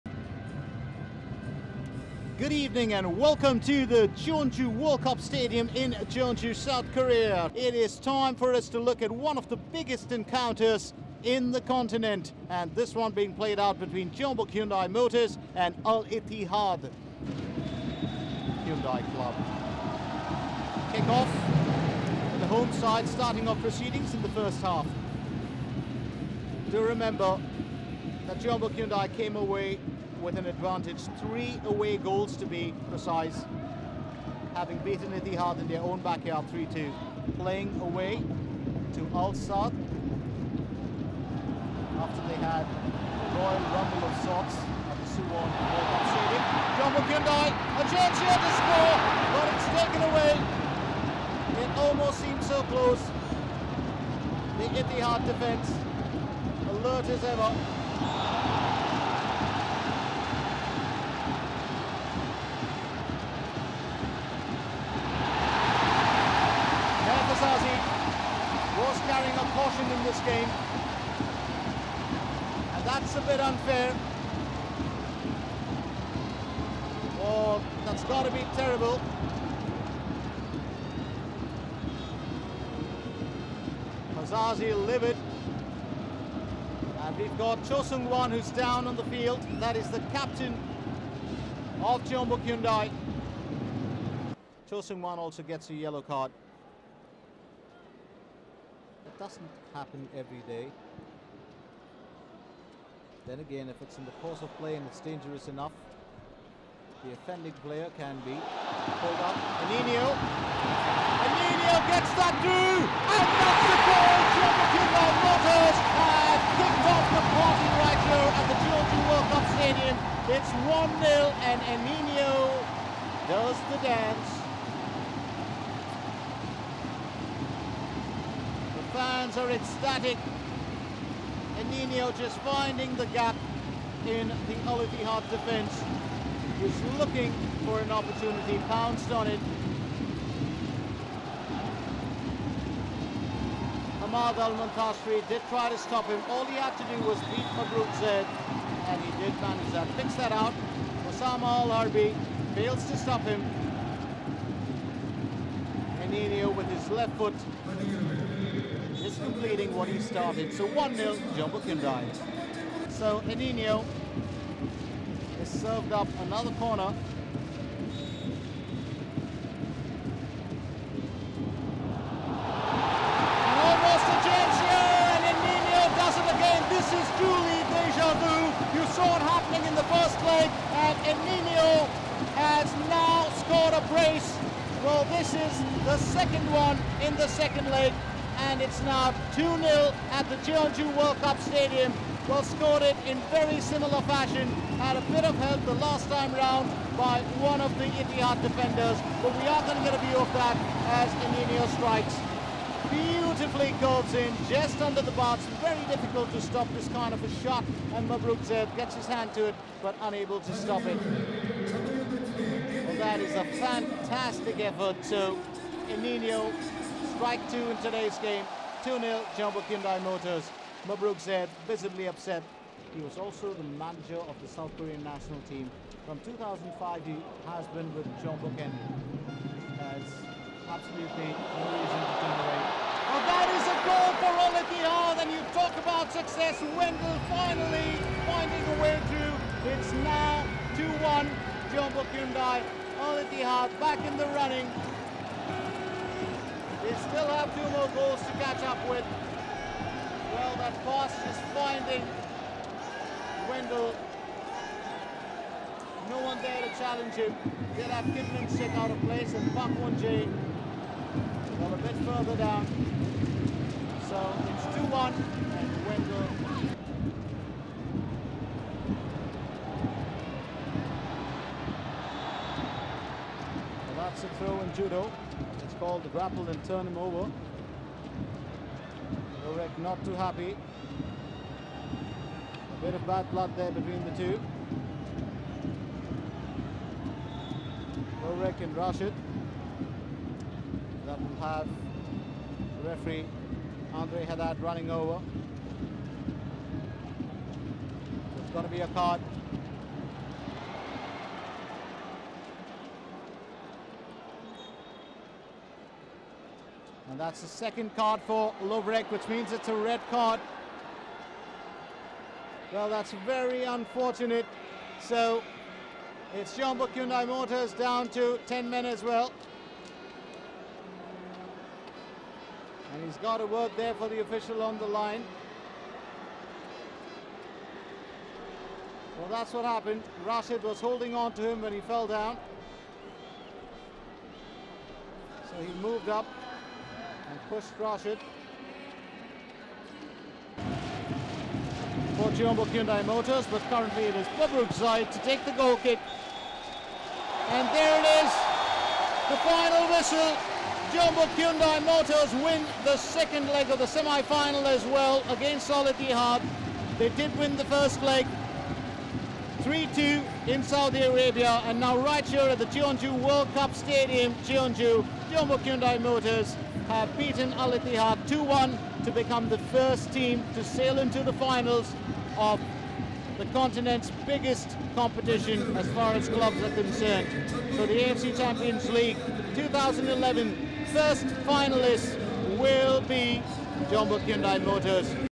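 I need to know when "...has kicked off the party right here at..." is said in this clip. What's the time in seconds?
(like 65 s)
116 s.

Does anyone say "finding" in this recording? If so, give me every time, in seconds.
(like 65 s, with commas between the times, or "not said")
132 s, 238 s, 251 s.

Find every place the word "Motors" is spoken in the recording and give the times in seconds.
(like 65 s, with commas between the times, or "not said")
14 s, 114 s, 220 s, 317 s, 343 s, 351 s, 366 s, 384 s.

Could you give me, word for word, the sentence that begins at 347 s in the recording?
And there it is, the final whistle.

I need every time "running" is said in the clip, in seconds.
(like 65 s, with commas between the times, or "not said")
244 s, 294 s.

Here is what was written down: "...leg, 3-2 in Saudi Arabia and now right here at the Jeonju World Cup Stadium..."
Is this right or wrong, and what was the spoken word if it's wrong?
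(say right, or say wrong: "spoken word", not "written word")
right.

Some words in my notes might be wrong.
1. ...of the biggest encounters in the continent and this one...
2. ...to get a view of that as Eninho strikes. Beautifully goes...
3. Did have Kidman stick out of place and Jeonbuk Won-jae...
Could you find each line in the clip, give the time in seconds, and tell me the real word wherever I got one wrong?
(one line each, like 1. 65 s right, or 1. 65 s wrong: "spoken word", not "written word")
1. 9 s right
2. 199 s right
3. 257 s wrong: "Park", not "Jeonbuk".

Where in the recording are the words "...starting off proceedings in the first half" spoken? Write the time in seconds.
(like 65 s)
23 s.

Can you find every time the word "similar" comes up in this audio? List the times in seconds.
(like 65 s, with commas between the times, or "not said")
193 s.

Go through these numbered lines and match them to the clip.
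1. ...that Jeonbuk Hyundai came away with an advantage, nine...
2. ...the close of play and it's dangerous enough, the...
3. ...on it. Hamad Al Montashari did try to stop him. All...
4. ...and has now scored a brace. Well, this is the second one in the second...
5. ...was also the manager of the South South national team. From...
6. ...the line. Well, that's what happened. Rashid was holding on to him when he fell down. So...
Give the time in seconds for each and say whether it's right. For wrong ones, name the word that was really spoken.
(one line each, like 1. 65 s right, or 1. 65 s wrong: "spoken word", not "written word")
1. 28 s wrong: "three", not "nine"
2. 104 s wrong: "course", not "close"
3. 139 s right
4. 181 s right
5. 223 s wrong: "Korean", not "South"
6. 324 s right.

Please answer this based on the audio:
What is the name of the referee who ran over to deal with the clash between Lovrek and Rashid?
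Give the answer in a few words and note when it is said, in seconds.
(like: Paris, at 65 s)
Andre Haddad, at 293 s.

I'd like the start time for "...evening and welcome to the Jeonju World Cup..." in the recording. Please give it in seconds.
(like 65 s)
2 s.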